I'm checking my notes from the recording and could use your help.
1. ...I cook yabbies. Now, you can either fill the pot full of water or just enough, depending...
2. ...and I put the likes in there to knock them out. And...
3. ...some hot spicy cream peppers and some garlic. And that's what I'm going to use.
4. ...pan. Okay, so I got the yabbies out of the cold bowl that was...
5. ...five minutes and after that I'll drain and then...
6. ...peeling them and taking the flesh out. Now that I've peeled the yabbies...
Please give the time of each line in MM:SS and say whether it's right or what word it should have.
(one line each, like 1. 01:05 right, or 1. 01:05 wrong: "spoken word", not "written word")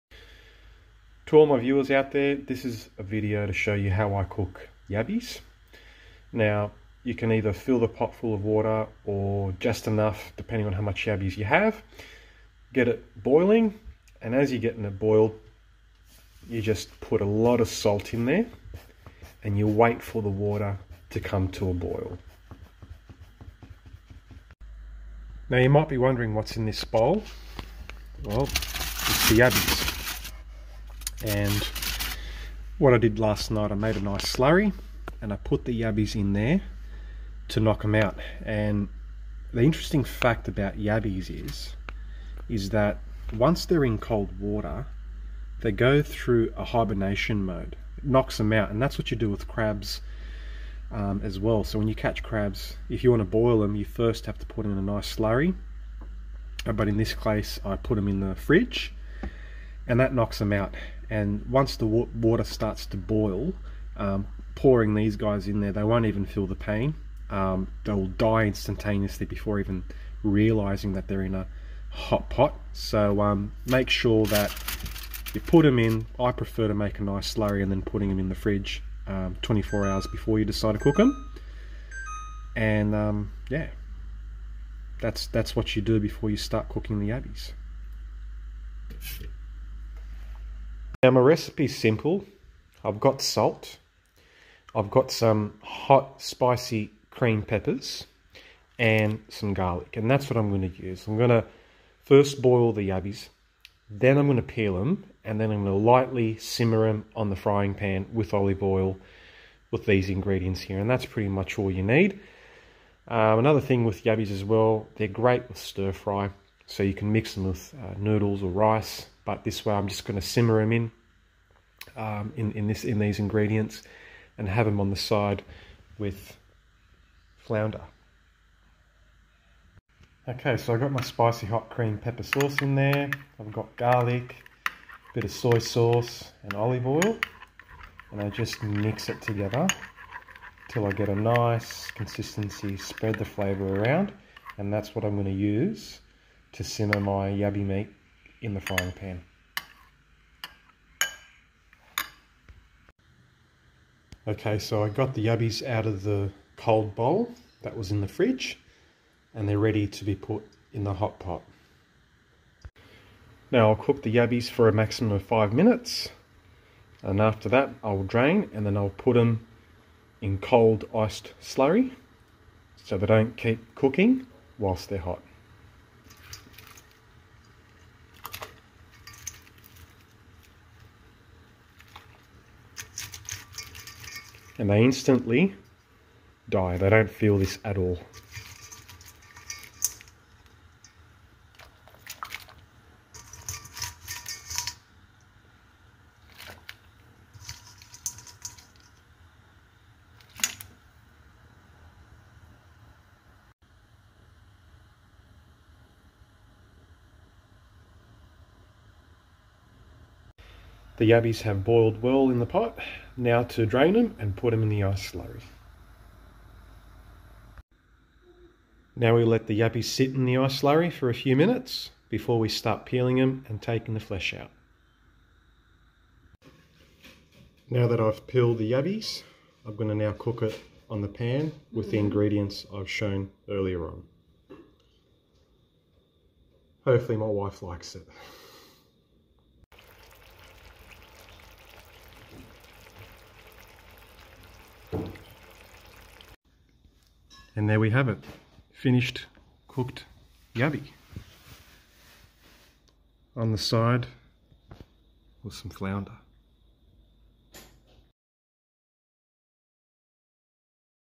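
1. 00:04 right
2. 00:35 wrong: "yabbies", not "likes"
3. 01:35 right
4. 02:28 right
5. 02:45 right
6. 03:42 right.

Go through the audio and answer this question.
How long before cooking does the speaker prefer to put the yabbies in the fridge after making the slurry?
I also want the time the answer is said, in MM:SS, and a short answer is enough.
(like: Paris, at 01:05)
24 hours, at 01:19.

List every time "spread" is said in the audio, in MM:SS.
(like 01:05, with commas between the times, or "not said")
02:22.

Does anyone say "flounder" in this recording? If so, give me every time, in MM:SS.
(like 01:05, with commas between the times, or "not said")
02:07, 04:15.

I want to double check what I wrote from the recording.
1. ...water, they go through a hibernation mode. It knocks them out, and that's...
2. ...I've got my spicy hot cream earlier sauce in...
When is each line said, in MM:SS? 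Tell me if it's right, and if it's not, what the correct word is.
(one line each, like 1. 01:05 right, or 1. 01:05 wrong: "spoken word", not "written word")
1. 00:44 right
2. 02:10 wrong: "pepper", not "earlier".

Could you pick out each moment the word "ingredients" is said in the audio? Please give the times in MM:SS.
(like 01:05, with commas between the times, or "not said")
01:50, 02:03, 03:51.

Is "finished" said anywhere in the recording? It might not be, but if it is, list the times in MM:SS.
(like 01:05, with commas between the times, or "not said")
04:08.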